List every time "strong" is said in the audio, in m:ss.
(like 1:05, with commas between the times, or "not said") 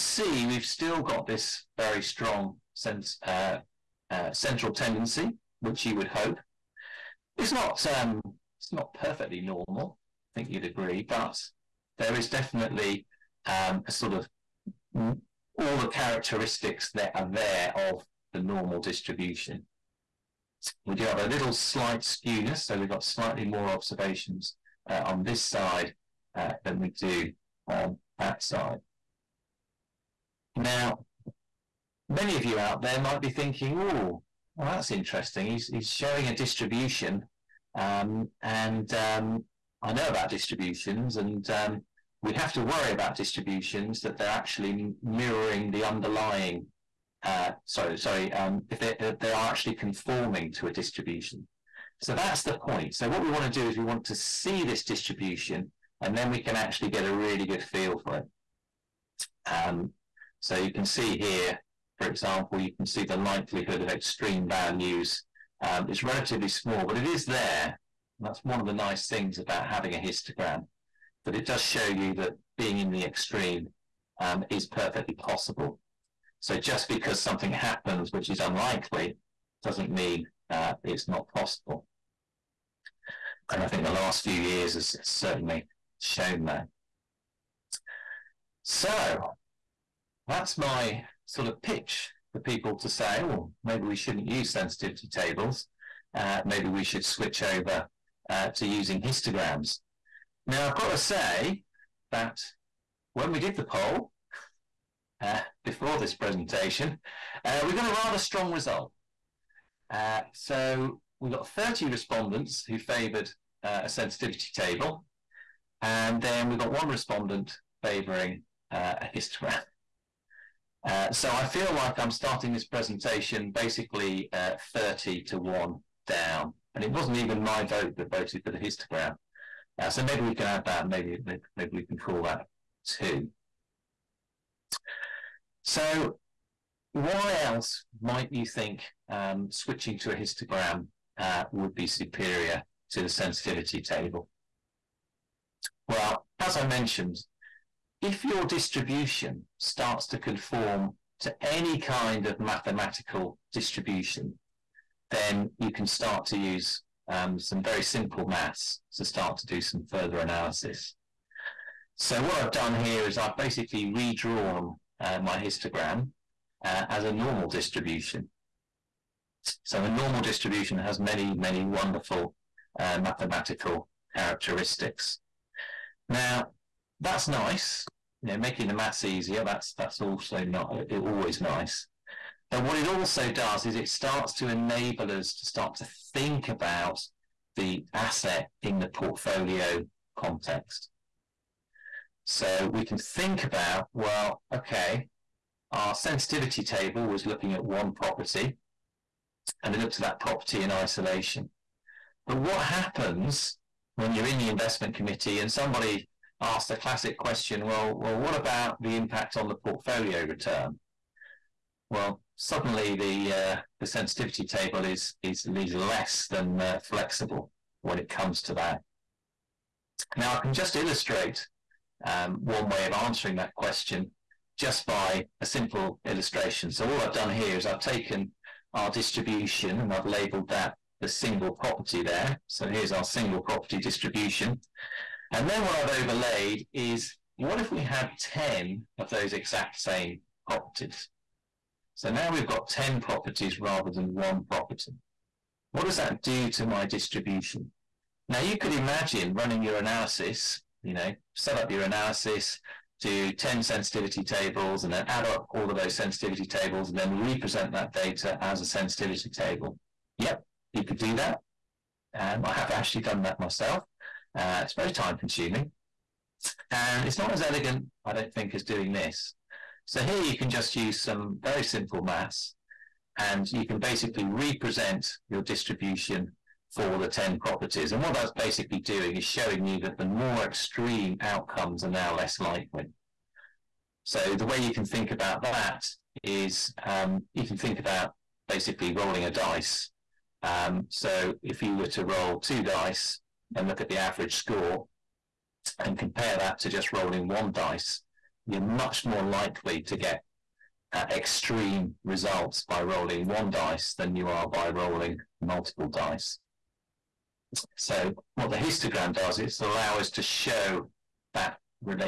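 0:02, 1:48.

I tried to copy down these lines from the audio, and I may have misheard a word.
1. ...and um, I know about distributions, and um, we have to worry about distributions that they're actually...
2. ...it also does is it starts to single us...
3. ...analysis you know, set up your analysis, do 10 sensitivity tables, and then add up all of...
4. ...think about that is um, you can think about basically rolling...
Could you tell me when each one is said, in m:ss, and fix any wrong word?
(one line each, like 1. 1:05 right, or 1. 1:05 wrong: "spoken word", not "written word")
1. 0:38 right
2. 3:02 wrong: "enable", not "single"
3. 4:09 right
4. 4:44 right.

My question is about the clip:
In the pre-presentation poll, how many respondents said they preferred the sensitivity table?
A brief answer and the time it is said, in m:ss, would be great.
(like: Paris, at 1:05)
30, at 1:51.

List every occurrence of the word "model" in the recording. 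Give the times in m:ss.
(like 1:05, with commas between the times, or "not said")
not said.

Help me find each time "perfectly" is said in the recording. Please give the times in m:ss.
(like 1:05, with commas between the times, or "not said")
0:08, 1:14.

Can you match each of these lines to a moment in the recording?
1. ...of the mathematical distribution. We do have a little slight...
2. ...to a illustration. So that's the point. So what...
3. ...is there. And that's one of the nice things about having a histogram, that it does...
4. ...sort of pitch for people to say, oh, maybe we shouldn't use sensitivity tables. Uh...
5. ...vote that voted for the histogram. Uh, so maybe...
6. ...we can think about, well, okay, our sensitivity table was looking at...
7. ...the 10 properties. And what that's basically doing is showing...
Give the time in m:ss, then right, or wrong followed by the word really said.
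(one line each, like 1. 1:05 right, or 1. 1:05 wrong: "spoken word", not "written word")
1. 0:17 wrong: "normal", not "mathematical"
2. 0:50 wrong: "distribution", not "illustration"
3. 1:07 right
4. 1:31 right
5. 2:07 right
6. 3:12 right
7. 4:36 right.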